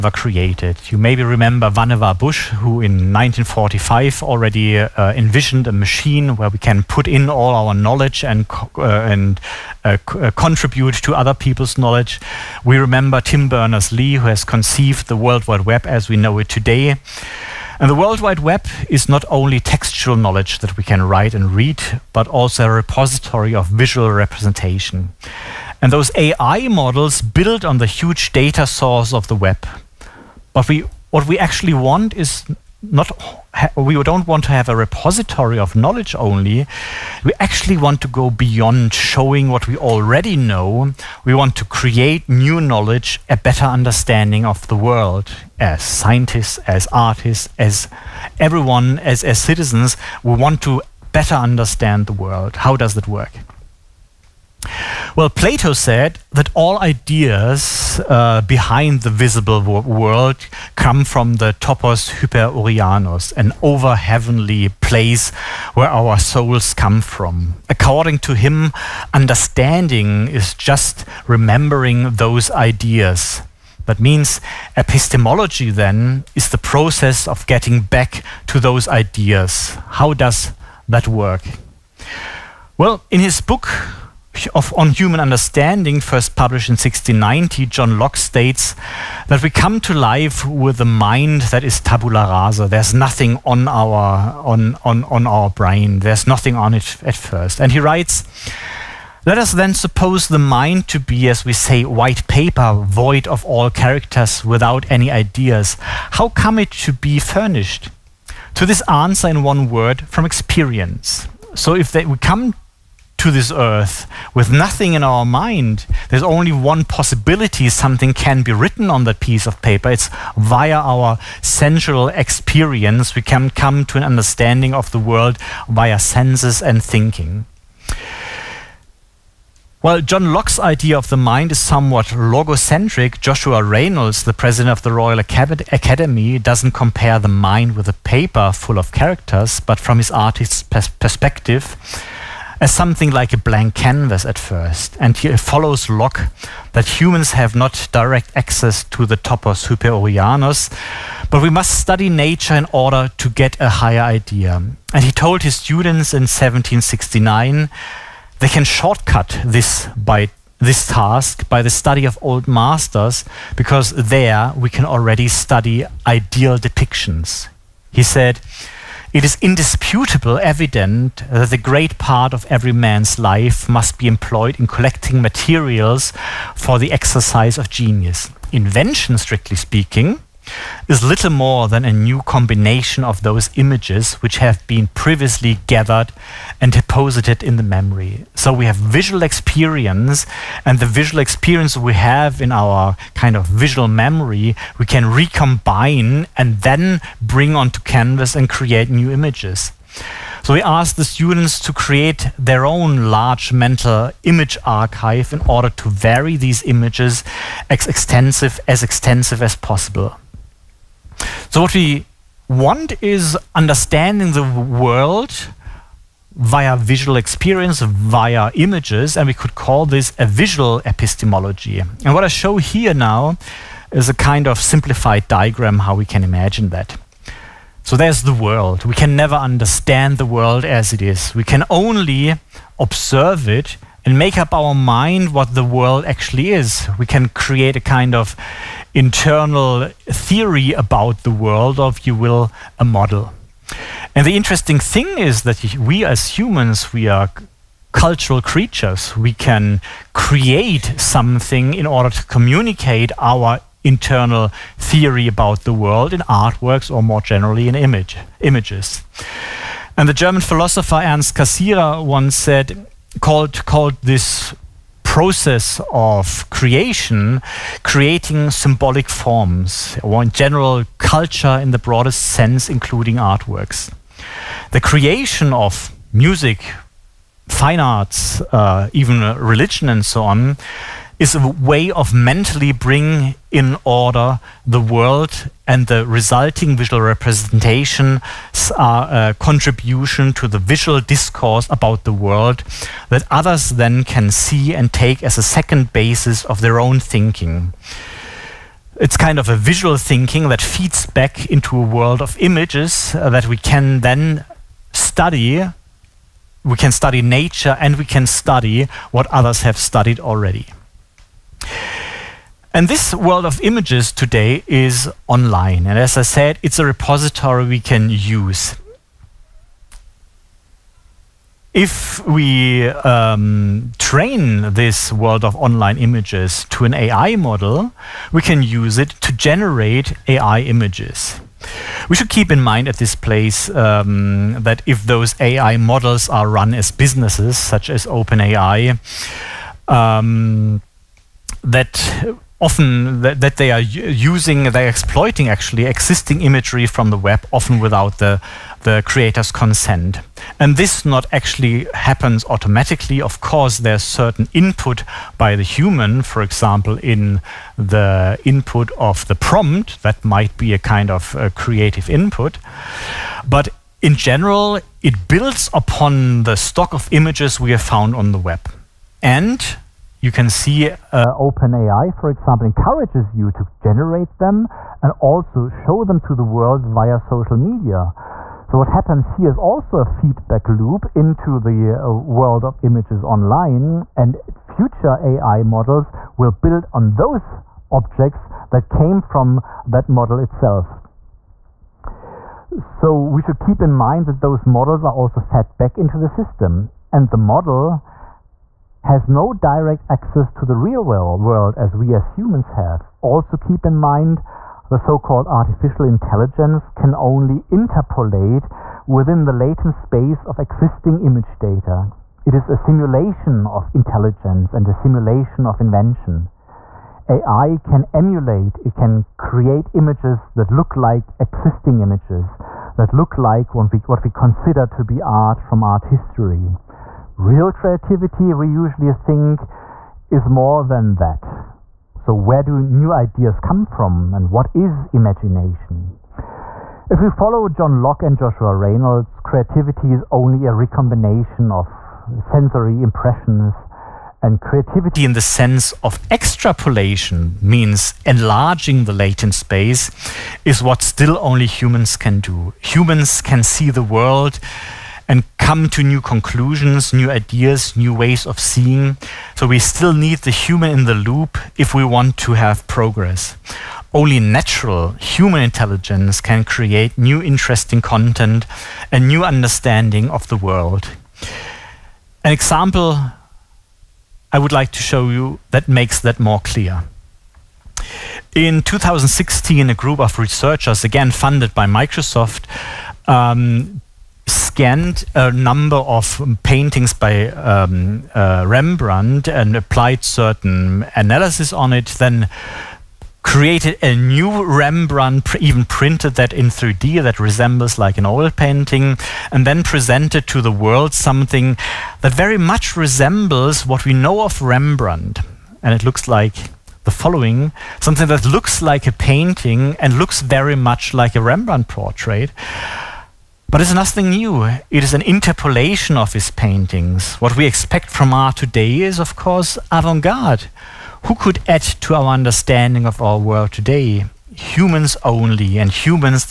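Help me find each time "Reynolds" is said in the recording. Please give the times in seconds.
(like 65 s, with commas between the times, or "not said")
133 s, 438 s.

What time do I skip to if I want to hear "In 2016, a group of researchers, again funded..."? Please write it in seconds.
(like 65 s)
478 s.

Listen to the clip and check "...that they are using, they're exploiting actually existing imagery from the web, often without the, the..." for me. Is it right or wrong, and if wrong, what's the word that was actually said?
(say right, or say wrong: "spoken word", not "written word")
right.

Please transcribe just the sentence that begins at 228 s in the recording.
We can never understand the world as it is.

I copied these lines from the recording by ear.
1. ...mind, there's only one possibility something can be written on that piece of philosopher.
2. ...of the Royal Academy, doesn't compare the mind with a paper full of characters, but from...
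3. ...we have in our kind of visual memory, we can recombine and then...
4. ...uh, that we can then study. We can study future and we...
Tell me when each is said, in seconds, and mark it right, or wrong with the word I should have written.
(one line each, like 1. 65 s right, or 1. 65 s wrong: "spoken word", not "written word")
1. 115 s wrong: "paper", not "philosopher"
2. 134 s right
3. 191 s right
4. 303 s wrong: "nature", not "future".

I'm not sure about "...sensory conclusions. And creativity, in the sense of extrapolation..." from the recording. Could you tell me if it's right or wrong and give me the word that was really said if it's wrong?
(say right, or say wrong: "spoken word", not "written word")
wrong: "impressions", not "conclusions".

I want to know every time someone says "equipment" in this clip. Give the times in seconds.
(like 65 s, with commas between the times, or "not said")
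not said.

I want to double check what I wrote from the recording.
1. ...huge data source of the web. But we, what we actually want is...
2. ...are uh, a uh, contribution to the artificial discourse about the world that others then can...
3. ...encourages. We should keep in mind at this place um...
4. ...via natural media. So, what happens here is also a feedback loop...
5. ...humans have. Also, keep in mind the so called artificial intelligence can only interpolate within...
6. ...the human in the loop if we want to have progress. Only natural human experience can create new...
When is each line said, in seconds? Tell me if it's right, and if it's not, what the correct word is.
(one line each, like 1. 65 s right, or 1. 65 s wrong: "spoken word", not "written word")
1. 27 s right
2. 288 s wrong: "visual", not "artificial"
3. 330 s wrong: "images", not "encourages"
4. 376 s wrong: "social", not "natural"
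5. 402 s right
6. 460 s wrong: "intelligence", not "experience".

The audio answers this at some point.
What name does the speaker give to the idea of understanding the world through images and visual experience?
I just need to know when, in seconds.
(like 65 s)
220 s.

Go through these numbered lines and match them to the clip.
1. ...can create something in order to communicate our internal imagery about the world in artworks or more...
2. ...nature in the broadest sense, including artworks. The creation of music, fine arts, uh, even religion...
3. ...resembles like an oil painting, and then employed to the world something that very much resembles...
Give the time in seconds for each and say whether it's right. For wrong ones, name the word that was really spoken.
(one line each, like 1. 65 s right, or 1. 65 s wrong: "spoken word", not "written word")
1. 249 s wrong: "theory", not "imagery"
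2. 270 s wrong: "culture", not "nature"
3. 497 s wrong: "presented", not "employed".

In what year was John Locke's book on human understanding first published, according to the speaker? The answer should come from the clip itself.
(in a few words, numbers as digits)
1690.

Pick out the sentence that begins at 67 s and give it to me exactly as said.
According to him, understanding is just remembering those ideas.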